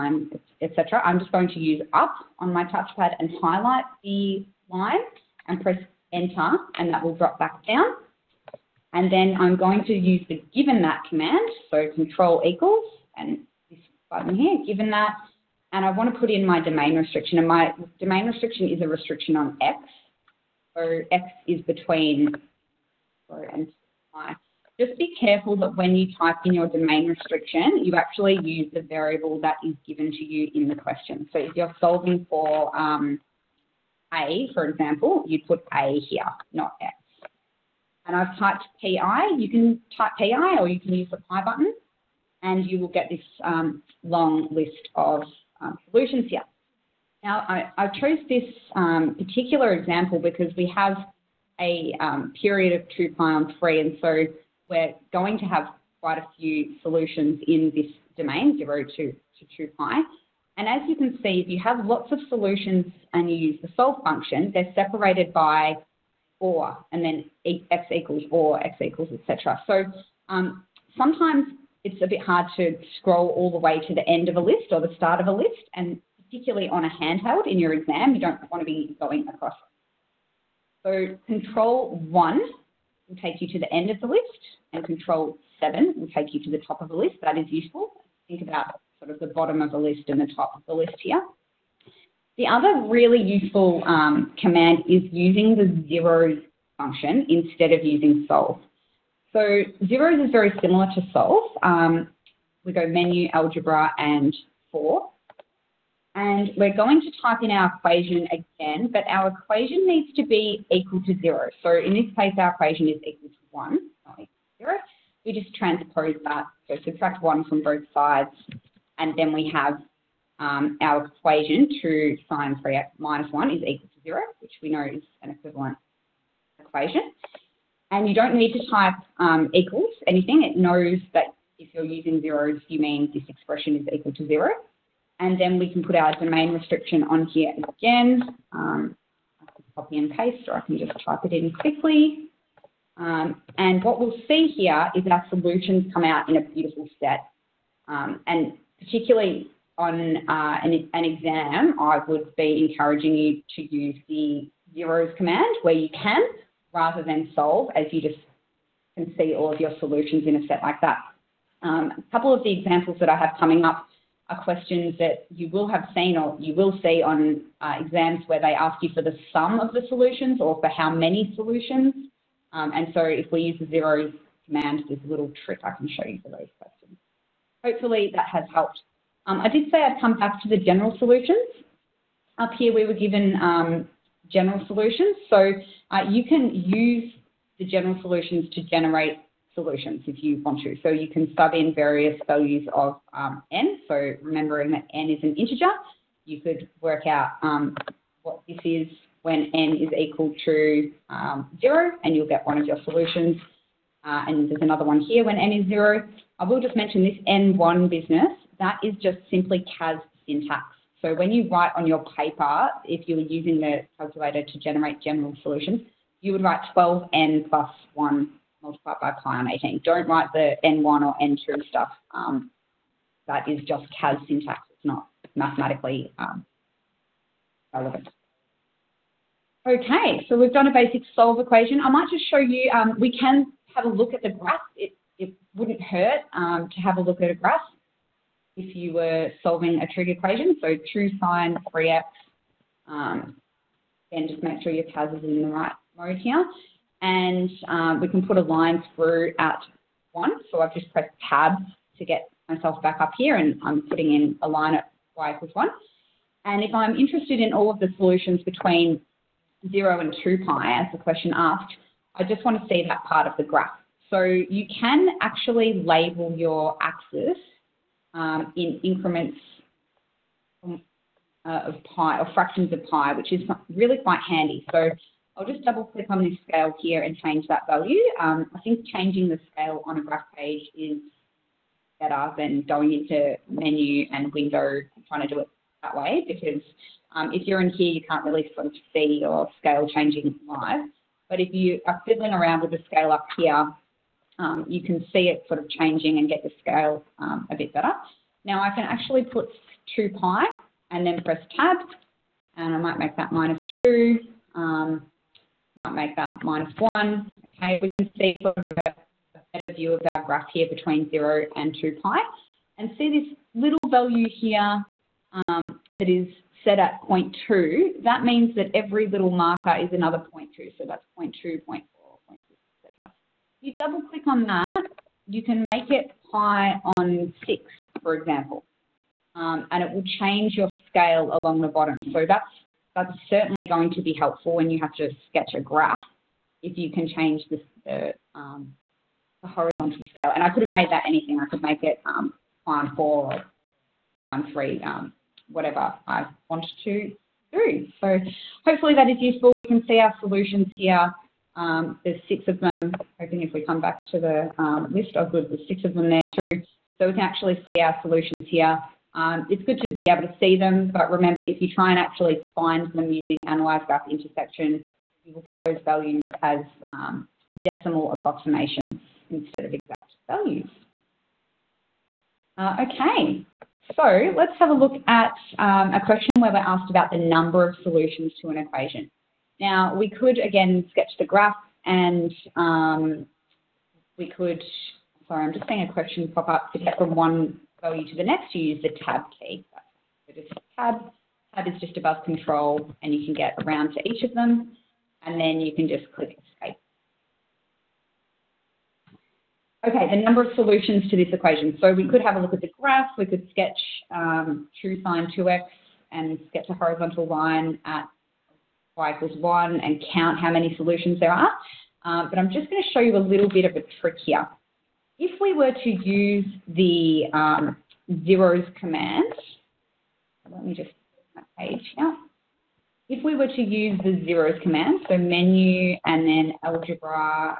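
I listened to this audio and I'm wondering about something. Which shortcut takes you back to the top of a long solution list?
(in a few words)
Control 7.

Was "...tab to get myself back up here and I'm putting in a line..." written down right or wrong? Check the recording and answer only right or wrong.
right.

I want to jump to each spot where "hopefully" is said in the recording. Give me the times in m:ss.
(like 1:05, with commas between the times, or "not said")
2:57, 5:48.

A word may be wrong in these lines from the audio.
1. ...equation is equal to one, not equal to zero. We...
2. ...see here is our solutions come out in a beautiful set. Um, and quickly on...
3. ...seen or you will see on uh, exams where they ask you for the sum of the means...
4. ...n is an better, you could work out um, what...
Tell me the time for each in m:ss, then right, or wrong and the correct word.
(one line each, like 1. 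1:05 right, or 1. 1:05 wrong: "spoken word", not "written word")
1. 1:52 right
2. 2:24 wrong: "particularly", not "quickly"
3. 2:45 wrong: "solutions", not "means"
4. 3:14 wrong: "integer", not "better".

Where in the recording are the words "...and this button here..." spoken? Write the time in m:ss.
0:13.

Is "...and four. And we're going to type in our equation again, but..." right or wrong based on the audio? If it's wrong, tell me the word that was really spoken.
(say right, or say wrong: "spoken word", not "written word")
right.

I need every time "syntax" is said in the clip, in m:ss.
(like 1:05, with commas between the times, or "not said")
3:30, 3:44.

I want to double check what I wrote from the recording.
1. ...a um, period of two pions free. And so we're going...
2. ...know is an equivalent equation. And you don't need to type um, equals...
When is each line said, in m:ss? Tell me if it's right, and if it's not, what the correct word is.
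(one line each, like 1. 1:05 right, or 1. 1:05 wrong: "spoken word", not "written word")
1. 0:51 right
2. 2:04 right.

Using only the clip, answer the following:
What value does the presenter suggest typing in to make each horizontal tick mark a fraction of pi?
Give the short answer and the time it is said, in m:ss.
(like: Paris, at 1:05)
pi on 6, at 5:26.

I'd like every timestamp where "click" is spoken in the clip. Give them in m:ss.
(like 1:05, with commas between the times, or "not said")
4:35, 5:24, 6:36.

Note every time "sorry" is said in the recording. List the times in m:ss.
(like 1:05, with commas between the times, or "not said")
0:23, 6:25.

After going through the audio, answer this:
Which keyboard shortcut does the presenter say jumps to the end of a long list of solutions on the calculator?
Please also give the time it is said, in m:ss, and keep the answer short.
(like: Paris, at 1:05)
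Control 1, at 1:21.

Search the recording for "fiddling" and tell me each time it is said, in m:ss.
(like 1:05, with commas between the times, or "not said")
4:52.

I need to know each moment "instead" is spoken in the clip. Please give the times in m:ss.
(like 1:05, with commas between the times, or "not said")
1:37, 6:09.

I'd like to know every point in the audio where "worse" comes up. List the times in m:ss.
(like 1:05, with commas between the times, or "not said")
not said.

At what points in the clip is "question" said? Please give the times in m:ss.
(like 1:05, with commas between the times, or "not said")
0:30, 2:44, 2:56, 4:20, 6:16, 6:25.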